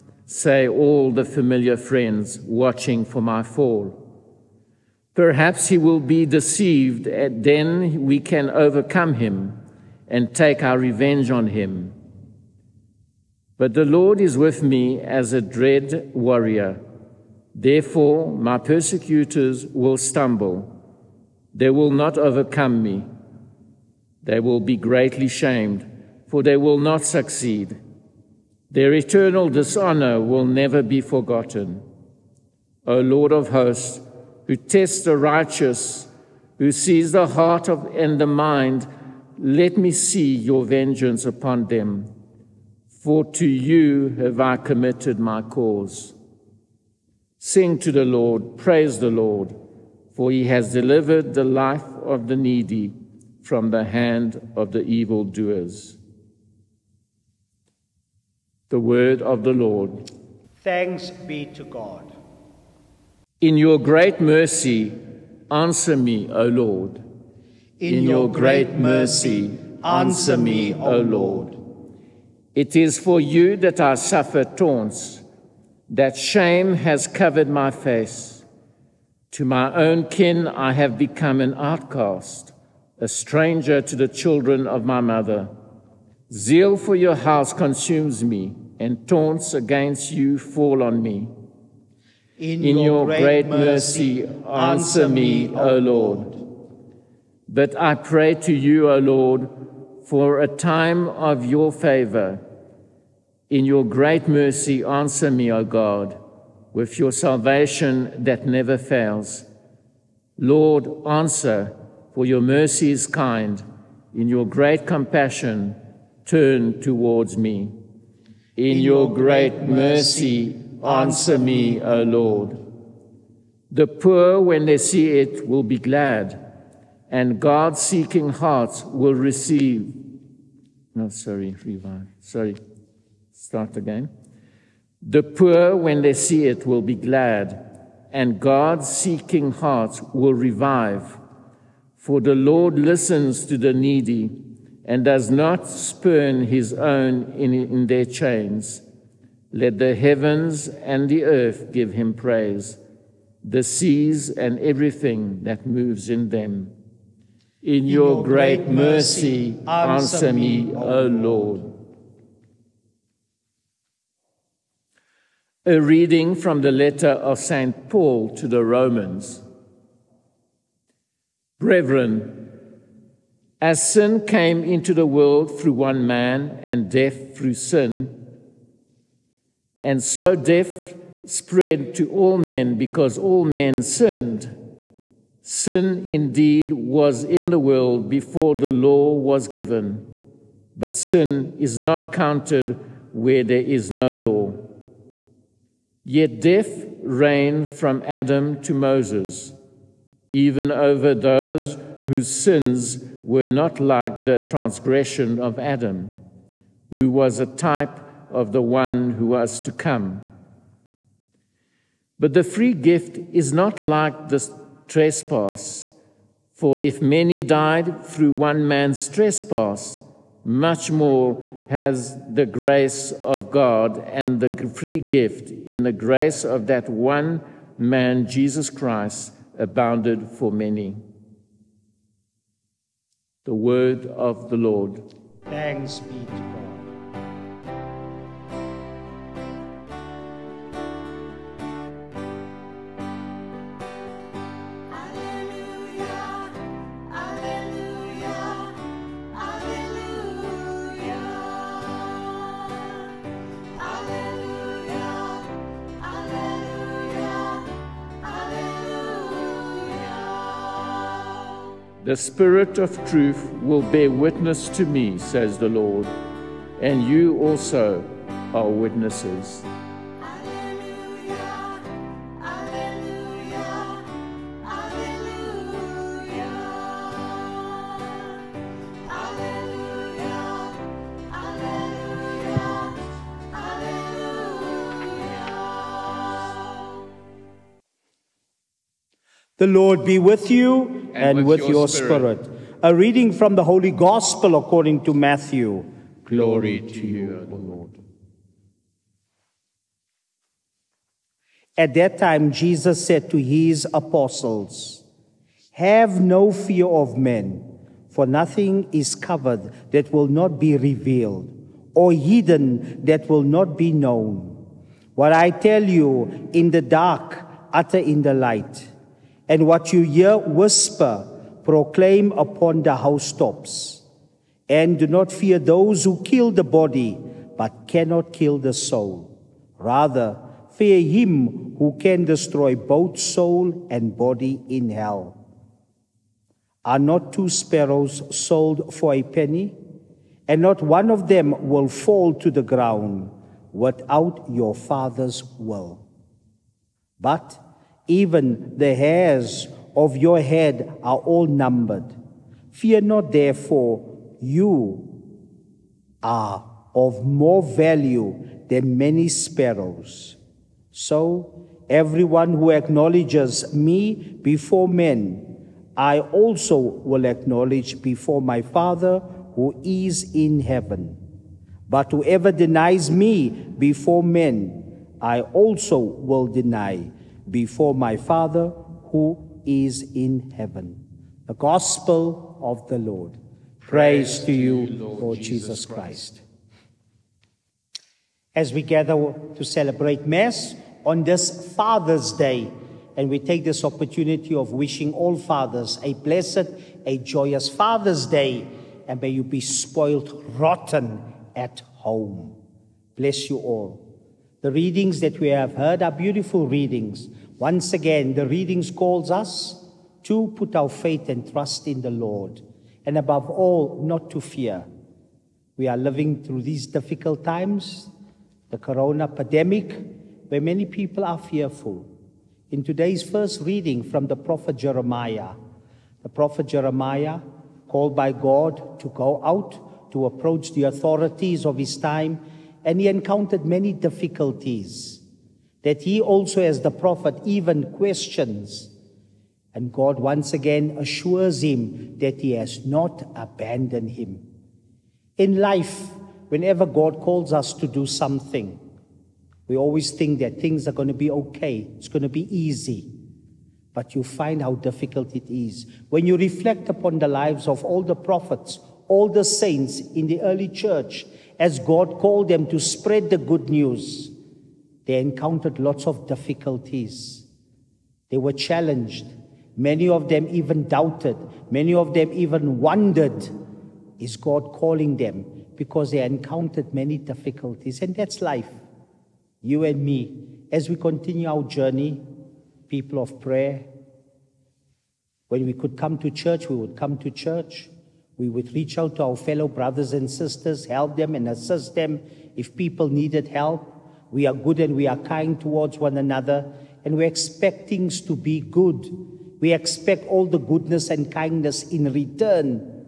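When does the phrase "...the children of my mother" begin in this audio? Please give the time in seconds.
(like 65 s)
83 s.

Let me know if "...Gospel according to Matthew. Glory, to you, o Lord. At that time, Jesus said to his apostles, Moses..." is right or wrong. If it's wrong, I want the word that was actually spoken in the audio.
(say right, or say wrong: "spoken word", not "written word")
wrong: "Have", not "Moses".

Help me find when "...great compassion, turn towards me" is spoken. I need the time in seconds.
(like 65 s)
114 s.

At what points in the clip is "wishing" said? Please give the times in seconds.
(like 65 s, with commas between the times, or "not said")
394 s.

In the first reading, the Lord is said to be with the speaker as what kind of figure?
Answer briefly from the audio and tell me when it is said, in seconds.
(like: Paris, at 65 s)
a dread warrior, at 15 s.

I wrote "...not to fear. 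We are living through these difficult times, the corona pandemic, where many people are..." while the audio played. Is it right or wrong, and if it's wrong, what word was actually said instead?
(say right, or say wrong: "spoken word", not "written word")
right.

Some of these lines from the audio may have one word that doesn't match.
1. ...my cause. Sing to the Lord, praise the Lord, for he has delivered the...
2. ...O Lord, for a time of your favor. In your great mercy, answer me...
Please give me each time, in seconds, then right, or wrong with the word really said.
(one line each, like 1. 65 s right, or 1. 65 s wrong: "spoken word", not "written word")
1. 45 s right
2. 98 s right.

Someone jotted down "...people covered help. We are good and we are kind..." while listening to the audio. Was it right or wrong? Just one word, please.
wrong.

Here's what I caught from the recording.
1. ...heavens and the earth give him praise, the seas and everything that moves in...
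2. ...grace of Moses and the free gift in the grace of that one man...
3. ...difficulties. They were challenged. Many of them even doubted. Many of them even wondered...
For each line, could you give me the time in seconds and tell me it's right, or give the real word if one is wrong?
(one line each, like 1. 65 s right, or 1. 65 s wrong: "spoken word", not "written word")
1. 149 s right
2. 222 s wrong: "God", not "Moses"
3. 466 s right.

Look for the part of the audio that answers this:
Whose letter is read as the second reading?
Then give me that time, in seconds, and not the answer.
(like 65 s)
167 s.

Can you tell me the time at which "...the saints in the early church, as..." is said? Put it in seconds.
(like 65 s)
459 s.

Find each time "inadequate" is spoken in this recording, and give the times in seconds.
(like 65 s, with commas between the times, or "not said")
not said.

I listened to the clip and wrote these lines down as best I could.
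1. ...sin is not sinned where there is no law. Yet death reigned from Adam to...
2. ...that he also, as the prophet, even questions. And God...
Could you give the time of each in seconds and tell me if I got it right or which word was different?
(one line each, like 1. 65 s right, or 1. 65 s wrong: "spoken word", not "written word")
1. 190 s wrong: "counted", not "sinned"
2. 435 s right.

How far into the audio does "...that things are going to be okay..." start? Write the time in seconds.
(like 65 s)
450 s.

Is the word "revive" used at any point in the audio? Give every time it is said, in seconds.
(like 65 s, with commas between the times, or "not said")
131 s, 140 s.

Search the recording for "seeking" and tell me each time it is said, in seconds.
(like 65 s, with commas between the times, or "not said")
127 s, 138 s.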